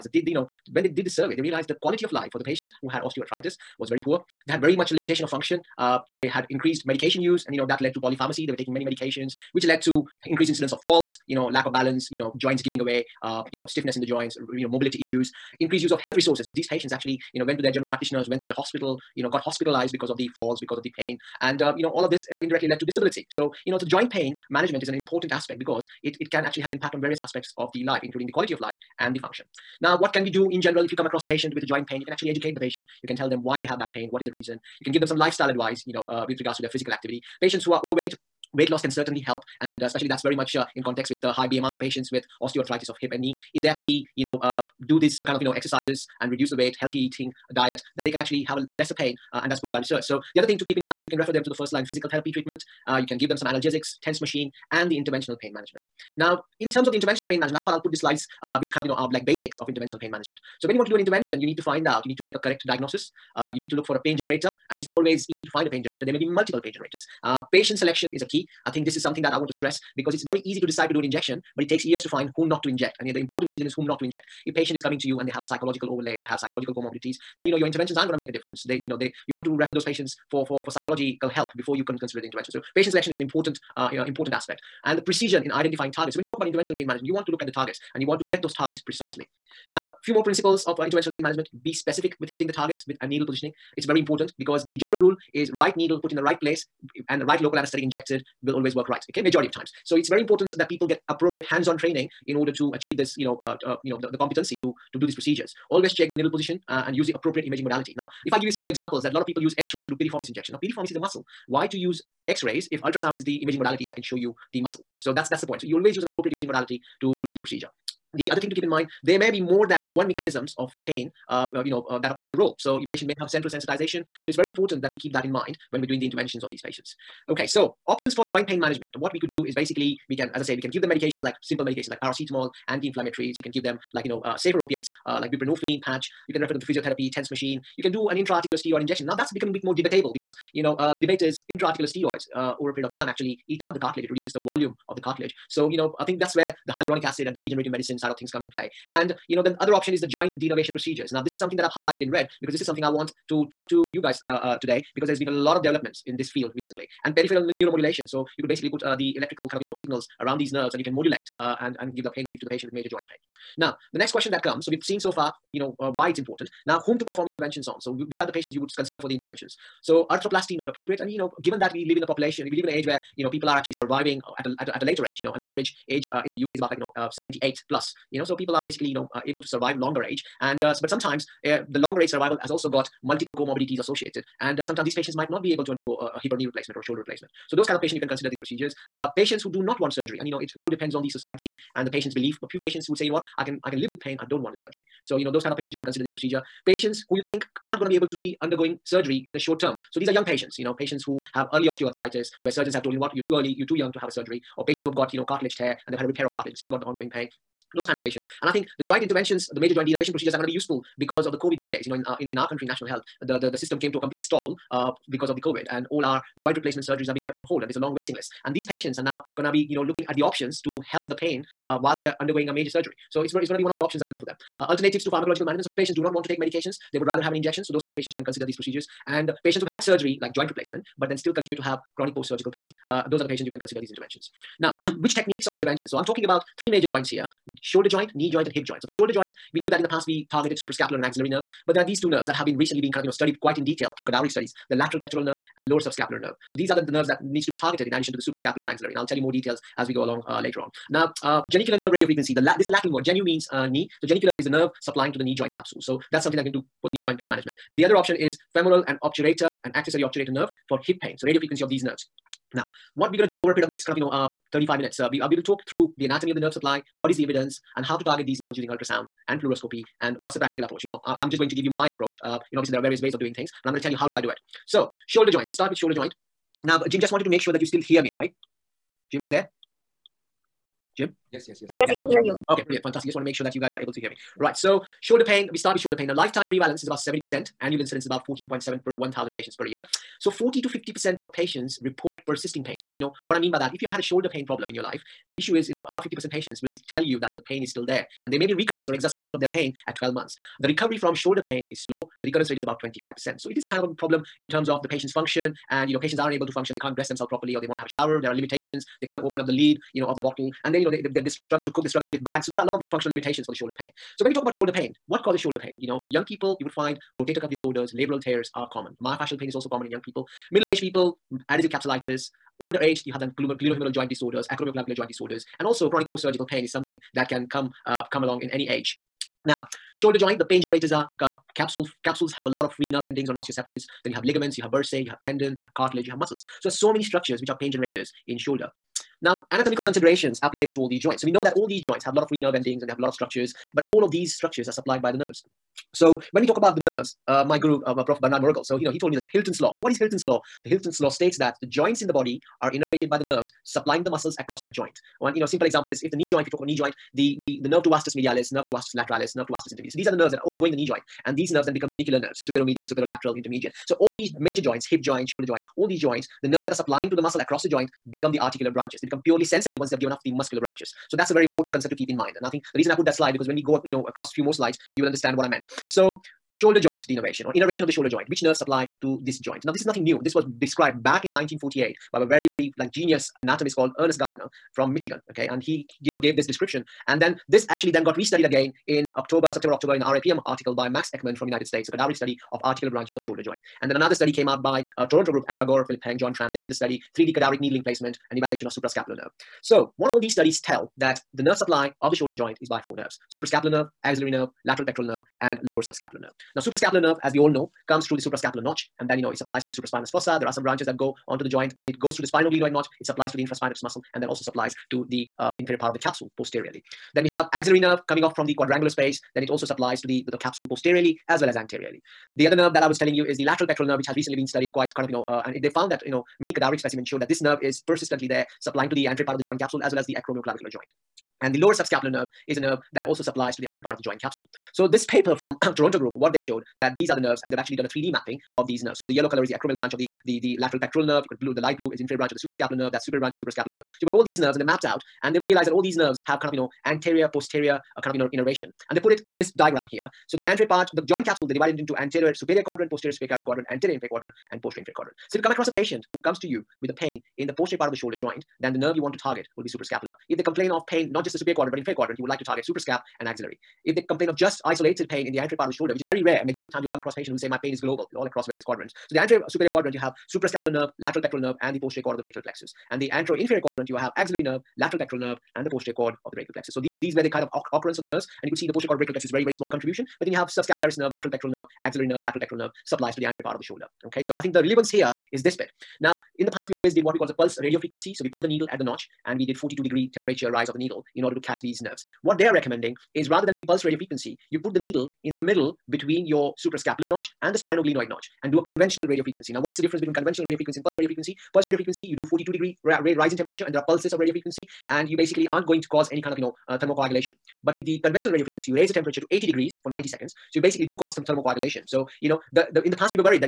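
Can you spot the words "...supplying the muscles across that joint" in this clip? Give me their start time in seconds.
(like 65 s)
353 s.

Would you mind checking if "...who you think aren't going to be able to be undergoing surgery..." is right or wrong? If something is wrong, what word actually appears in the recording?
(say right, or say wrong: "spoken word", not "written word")
right.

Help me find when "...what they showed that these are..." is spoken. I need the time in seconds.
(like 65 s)
436 s.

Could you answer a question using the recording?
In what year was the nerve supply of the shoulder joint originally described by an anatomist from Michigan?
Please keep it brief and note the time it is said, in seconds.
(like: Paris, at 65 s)
1948, at 381 s.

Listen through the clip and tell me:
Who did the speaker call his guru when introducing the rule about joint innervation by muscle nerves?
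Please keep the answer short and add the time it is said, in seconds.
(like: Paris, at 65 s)
Bernhard Moriggl, at 348 s.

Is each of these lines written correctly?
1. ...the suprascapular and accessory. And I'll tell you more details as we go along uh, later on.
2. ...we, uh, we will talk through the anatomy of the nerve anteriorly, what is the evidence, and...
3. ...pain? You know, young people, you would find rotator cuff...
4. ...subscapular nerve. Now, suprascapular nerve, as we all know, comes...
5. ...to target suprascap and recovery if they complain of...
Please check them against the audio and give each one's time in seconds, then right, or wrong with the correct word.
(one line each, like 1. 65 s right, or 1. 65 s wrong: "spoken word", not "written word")
1. 248 s wrong: "axillary", not "accessory"
2. 265 s wrong: "supply", not "anteriorly"
3. 315 s right
4. 405 s right
5. 462 s wrong: "axillary", not "recovery".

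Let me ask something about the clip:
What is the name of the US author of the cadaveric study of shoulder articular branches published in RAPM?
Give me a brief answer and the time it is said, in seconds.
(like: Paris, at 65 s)
Max Eckmann, at 390 s.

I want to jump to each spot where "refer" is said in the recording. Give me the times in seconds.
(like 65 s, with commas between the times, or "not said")
51 s, 79 s, 136 s.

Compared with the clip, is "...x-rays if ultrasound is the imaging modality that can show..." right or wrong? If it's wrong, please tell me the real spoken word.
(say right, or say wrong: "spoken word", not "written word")
right.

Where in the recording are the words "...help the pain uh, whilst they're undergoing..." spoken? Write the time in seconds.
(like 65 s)
220 s.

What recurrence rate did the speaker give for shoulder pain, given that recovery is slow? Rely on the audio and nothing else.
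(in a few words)
25%.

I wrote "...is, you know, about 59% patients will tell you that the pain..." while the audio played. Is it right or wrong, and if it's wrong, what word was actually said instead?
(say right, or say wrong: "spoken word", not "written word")
wrong: "50", not "59".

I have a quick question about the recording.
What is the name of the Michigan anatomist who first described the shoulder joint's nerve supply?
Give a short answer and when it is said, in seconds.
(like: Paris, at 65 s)
Ernest Gardner, at 383 s.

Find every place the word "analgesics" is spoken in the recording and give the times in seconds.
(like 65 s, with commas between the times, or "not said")
53 s.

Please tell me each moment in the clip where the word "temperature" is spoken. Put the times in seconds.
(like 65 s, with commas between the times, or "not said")
490 s, 503 s, 508 s.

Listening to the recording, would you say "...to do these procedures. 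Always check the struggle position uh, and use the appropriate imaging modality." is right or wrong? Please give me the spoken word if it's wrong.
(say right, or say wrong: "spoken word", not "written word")
wrong: "needle", not "struggle".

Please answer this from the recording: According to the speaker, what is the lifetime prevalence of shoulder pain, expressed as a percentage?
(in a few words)
70%.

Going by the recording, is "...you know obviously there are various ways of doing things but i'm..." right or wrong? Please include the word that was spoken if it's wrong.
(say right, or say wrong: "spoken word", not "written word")
right.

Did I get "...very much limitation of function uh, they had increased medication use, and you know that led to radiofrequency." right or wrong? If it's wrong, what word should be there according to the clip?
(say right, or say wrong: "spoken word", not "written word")
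wrong: "polypharmacy", not "radiofrequency".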